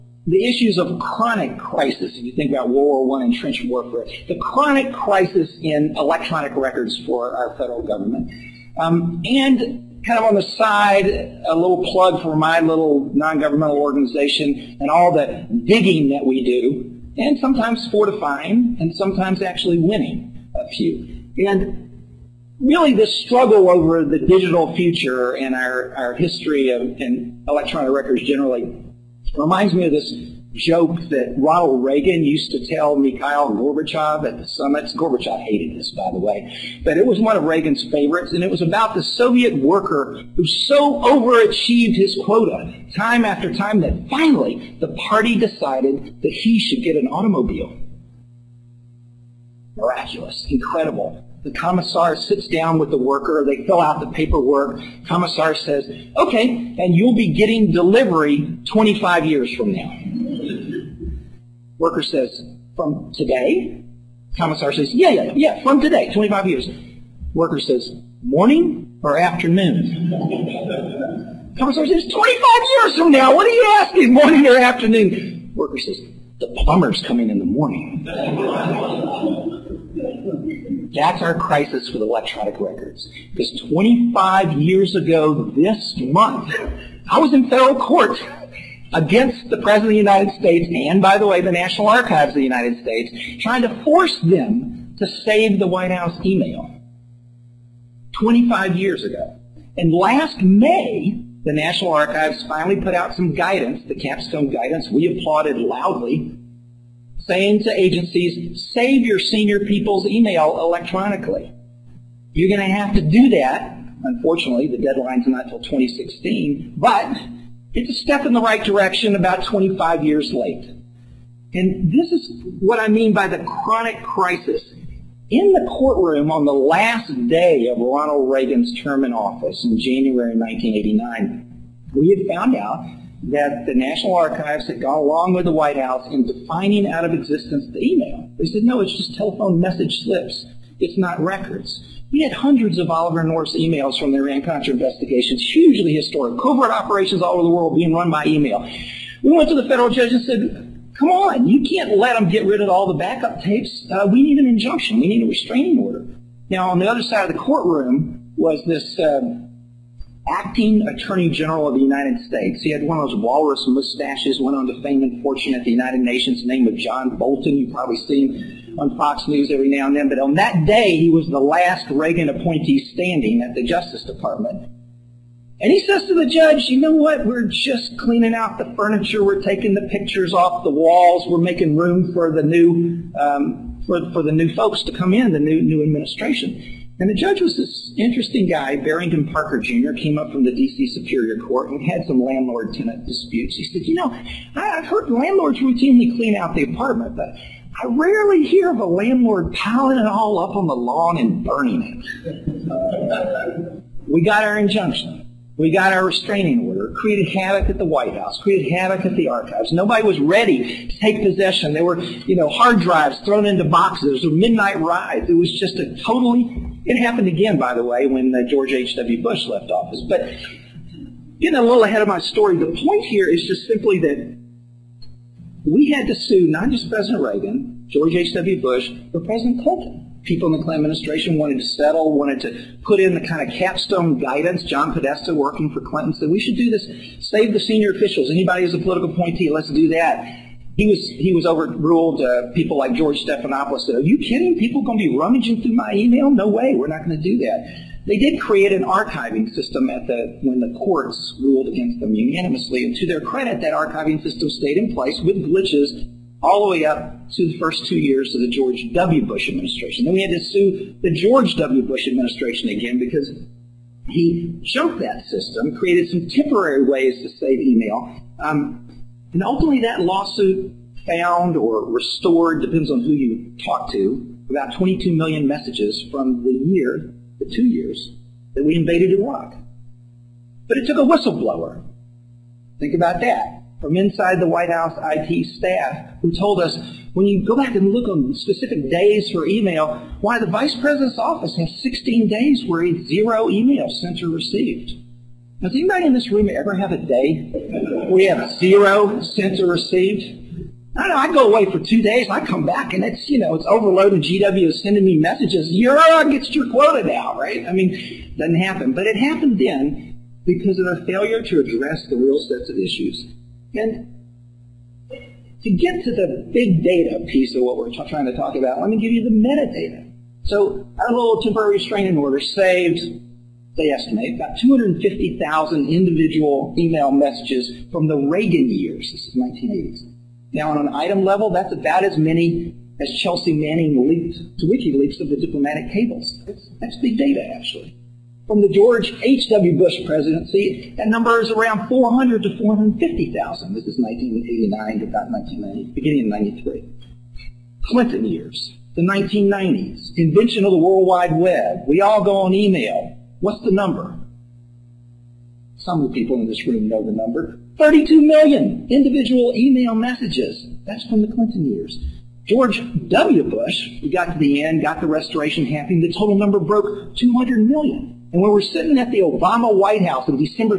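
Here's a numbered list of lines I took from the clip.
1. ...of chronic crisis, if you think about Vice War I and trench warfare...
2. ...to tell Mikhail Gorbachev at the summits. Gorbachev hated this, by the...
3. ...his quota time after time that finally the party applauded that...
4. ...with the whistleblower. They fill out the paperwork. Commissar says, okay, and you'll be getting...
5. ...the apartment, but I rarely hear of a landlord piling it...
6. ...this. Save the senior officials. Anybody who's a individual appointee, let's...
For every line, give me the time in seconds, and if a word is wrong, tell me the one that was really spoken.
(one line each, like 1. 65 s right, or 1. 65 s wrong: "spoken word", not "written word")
1. 0 s wrong: "World", not "Vice"
2. 32 s right
3. 41 s wrong: "decided", not "applauded"
4. 52 s wrong: "worker", not "whistleblower"
5. 196 s right
6. 236 s wrong: "political", not "individual".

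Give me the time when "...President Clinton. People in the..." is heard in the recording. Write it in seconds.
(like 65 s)
229 s.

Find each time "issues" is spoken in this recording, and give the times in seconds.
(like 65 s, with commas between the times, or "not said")
0 s, 312 s.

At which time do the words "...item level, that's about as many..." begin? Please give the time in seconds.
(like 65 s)
330 s.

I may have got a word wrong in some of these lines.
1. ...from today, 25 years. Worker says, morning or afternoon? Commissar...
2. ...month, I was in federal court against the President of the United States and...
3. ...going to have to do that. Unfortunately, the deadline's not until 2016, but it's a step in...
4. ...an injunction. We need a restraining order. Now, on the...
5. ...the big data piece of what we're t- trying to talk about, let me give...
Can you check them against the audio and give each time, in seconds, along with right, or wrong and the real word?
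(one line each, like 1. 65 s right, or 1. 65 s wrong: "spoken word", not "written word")
1. 65 s right
2. 85 s right
3. 112 s right
4. 154 s right
5. 316 s right.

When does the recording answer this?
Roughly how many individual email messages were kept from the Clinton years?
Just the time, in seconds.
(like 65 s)
357 s.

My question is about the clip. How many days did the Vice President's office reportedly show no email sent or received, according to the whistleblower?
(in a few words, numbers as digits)
16.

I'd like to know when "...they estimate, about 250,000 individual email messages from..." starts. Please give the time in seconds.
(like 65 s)
323 s.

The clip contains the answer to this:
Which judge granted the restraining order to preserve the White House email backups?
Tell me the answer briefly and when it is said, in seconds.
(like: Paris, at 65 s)
Barrington Parker Jr., at 188 s.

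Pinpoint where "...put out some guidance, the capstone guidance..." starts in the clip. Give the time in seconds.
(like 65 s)
102 s.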